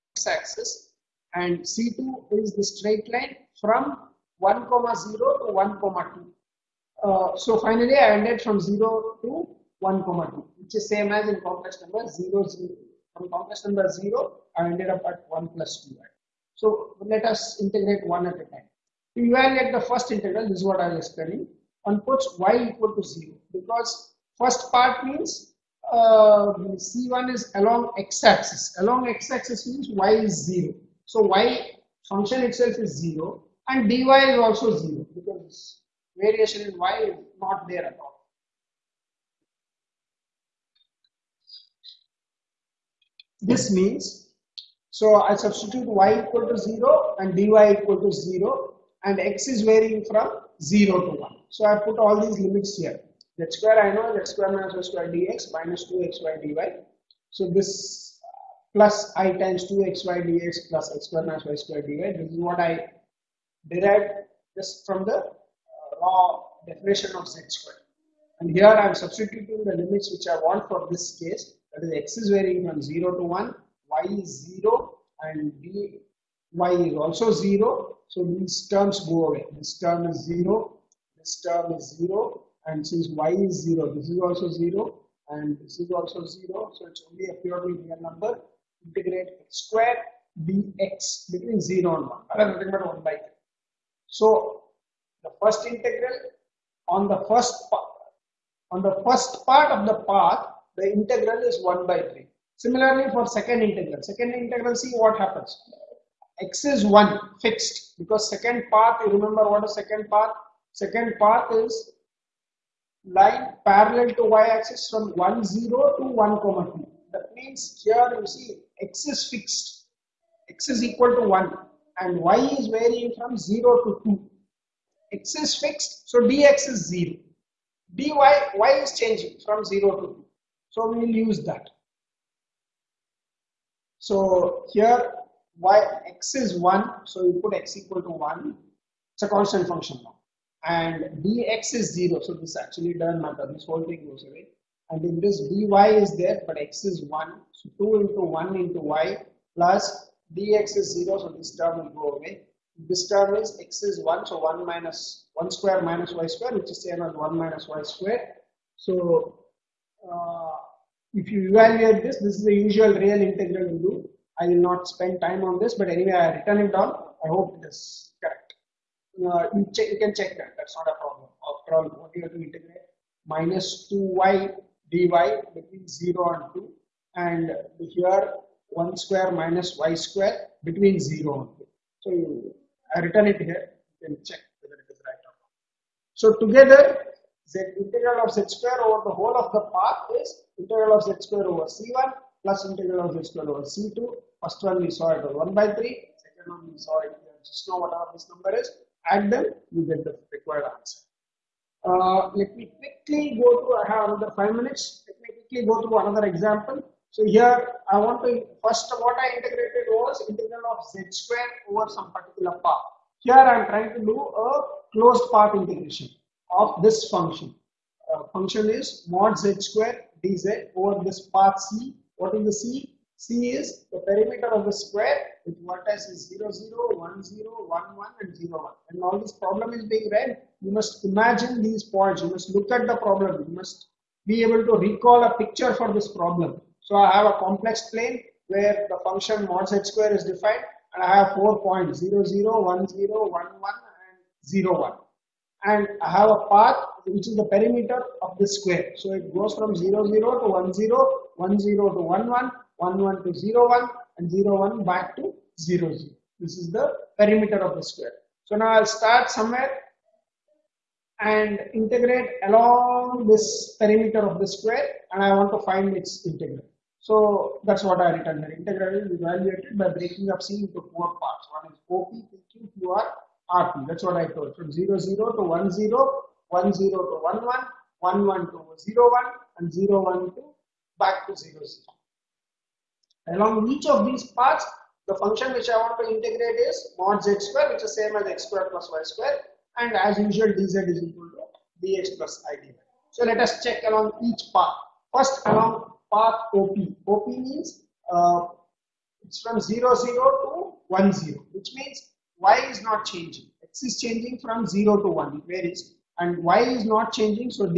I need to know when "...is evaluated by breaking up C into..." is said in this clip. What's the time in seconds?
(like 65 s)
269 s.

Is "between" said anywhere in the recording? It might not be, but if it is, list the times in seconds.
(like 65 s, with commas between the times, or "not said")
91 s, 175 s, 180 s.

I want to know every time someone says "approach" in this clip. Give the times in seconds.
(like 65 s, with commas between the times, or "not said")
not said.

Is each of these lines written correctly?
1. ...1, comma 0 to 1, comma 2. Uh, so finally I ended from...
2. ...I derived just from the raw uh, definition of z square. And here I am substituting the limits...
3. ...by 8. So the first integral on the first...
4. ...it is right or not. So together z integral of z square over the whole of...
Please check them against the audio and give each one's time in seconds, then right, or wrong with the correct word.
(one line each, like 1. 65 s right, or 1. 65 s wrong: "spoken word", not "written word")
1. 4 s right
2. 62 s right
3. 93 s wrong: "3", not "8"
4. 184 s right.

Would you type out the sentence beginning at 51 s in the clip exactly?
So I put all these limits here.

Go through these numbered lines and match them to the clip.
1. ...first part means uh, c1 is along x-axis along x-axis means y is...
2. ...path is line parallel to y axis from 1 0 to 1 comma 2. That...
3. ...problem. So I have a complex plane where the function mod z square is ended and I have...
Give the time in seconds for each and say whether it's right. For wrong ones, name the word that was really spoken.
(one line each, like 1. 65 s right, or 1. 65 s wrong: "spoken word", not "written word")
1. 24 s right
2. 111 s right
3. 236 s wrong: "defined", not "ended".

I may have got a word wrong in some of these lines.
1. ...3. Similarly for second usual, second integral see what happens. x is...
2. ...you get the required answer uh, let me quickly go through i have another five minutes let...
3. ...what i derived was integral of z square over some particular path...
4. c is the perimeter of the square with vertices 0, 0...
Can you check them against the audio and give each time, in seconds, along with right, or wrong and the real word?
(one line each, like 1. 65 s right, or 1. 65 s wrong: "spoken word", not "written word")
1. 101 s wrong: "integral", not "usual"
2. 199 s right
3. 209 s wrong: "integrated", not "derived"
4. 223 s right.